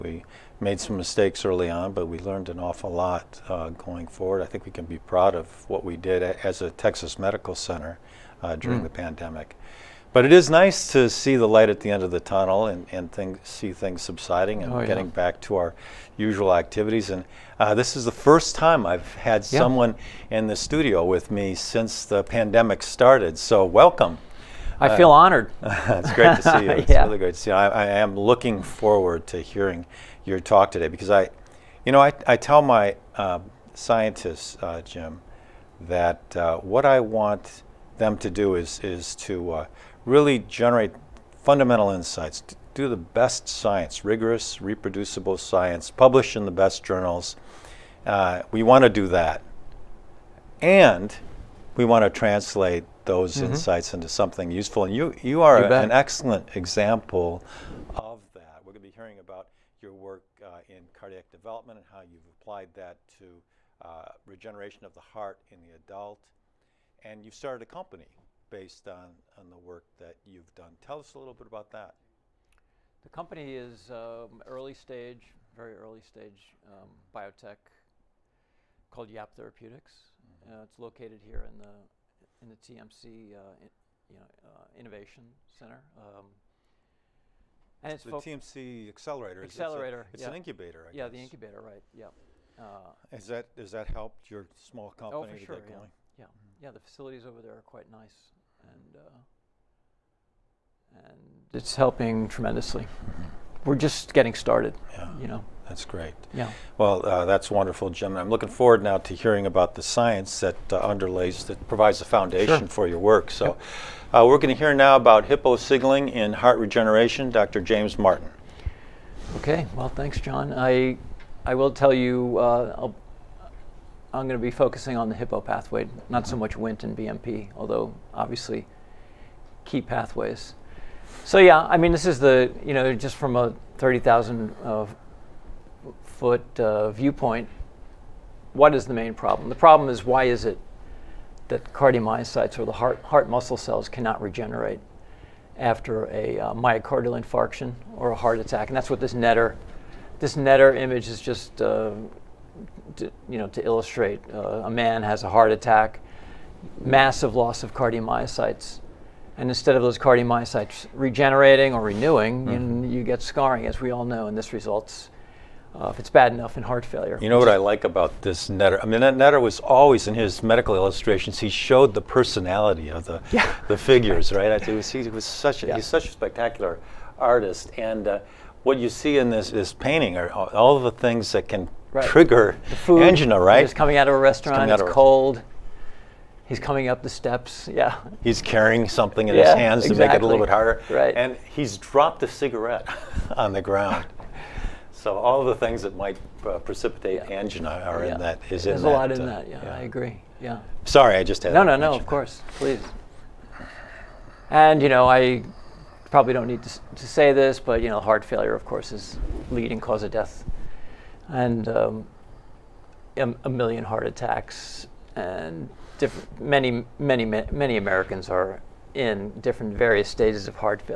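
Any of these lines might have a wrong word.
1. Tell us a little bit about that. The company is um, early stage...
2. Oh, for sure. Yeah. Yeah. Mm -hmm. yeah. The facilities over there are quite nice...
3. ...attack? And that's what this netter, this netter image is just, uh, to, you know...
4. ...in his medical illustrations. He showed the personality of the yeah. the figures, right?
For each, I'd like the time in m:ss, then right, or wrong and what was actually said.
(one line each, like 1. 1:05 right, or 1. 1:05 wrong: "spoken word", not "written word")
1. 1:10 right
2. 1:35 right
3. 2:28 right
4. 2:50 right.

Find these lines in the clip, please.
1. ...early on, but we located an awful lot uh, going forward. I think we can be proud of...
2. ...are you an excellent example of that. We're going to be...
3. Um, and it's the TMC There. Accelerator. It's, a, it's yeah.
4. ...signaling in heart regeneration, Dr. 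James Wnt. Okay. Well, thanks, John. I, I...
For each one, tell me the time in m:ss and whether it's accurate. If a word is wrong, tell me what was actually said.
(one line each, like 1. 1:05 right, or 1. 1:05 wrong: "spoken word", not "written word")
1. 0:01 wrong: "learned", not "located"
2. 0:55 right
3. 1:25 wrong: "Accelerator", not "There"
4. 1:55 wrong: "Martin", not "Wnt".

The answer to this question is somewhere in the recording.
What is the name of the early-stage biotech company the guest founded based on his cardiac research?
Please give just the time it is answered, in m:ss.
1:19.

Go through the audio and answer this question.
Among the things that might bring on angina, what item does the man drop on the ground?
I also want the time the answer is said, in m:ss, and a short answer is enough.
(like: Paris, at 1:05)
A cigarette, at 3:12.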